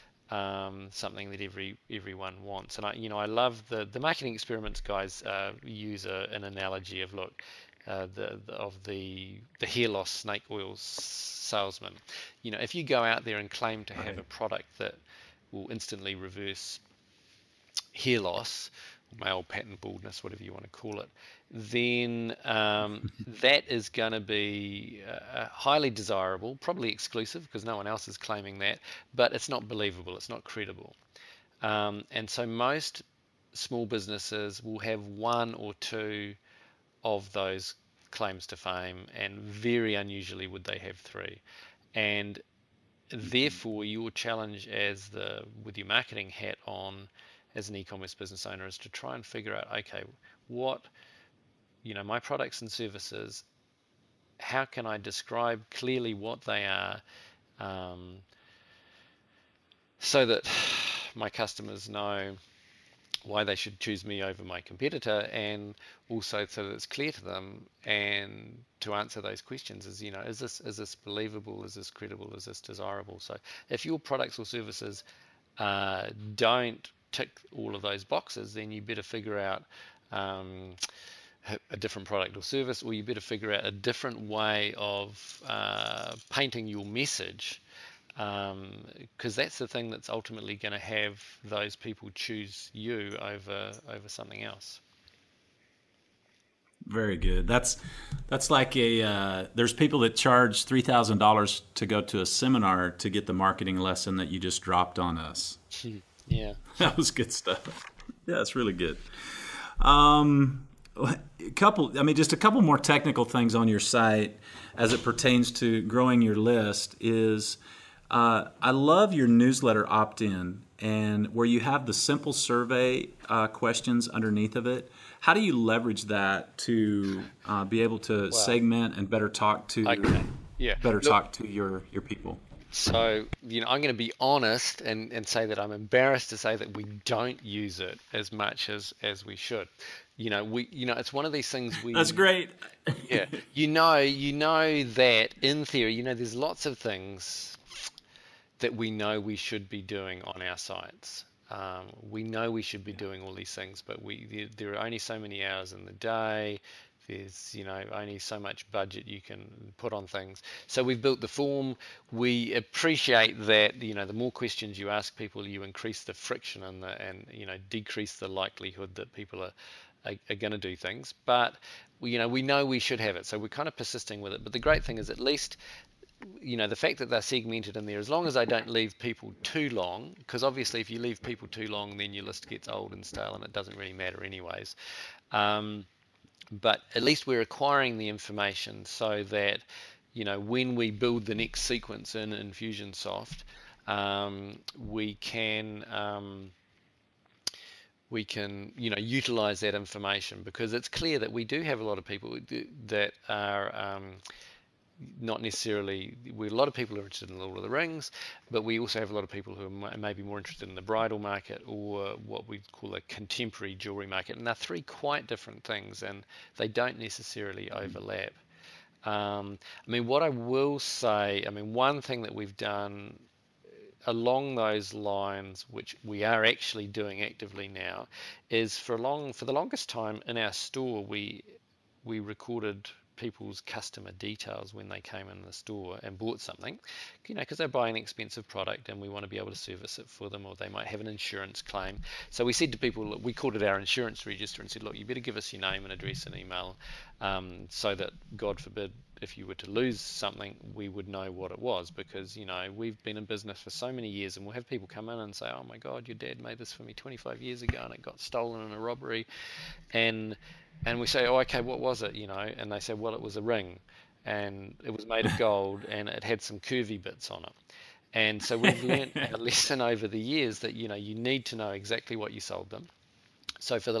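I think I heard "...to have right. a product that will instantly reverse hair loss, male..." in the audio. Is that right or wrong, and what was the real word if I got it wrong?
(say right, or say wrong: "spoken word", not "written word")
right.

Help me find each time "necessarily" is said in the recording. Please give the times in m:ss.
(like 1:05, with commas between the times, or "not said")
3:25, 3:36.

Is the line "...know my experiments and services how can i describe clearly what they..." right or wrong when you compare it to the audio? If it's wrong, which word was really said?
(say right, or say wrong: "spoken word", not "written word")
wrong: "products", not "experiments".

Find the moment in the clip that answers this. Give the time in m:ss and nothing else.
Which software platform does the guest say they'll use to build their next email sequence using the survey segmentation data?
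3:12.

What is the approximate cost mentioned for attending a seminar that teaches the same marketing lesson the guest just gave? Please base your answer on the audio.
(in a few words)
$3,000.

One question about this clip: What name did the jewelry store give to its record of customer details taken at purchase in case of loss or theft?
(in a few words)
insurance register.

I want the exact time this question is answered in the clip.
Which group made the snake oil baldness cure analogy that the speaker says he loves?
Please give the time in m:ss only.
0:03.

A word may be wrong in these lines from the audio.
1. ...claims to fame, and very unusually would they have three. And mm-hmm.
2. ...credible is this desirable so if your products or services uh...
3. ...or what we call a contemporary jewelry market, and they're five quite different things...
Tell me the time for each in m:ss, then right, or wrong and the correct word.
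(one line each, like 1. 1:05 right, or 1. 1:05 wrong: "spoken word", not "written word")
1. 0:38 right
2. 1:11 right
3. 3:31 wrong: "three", not "five".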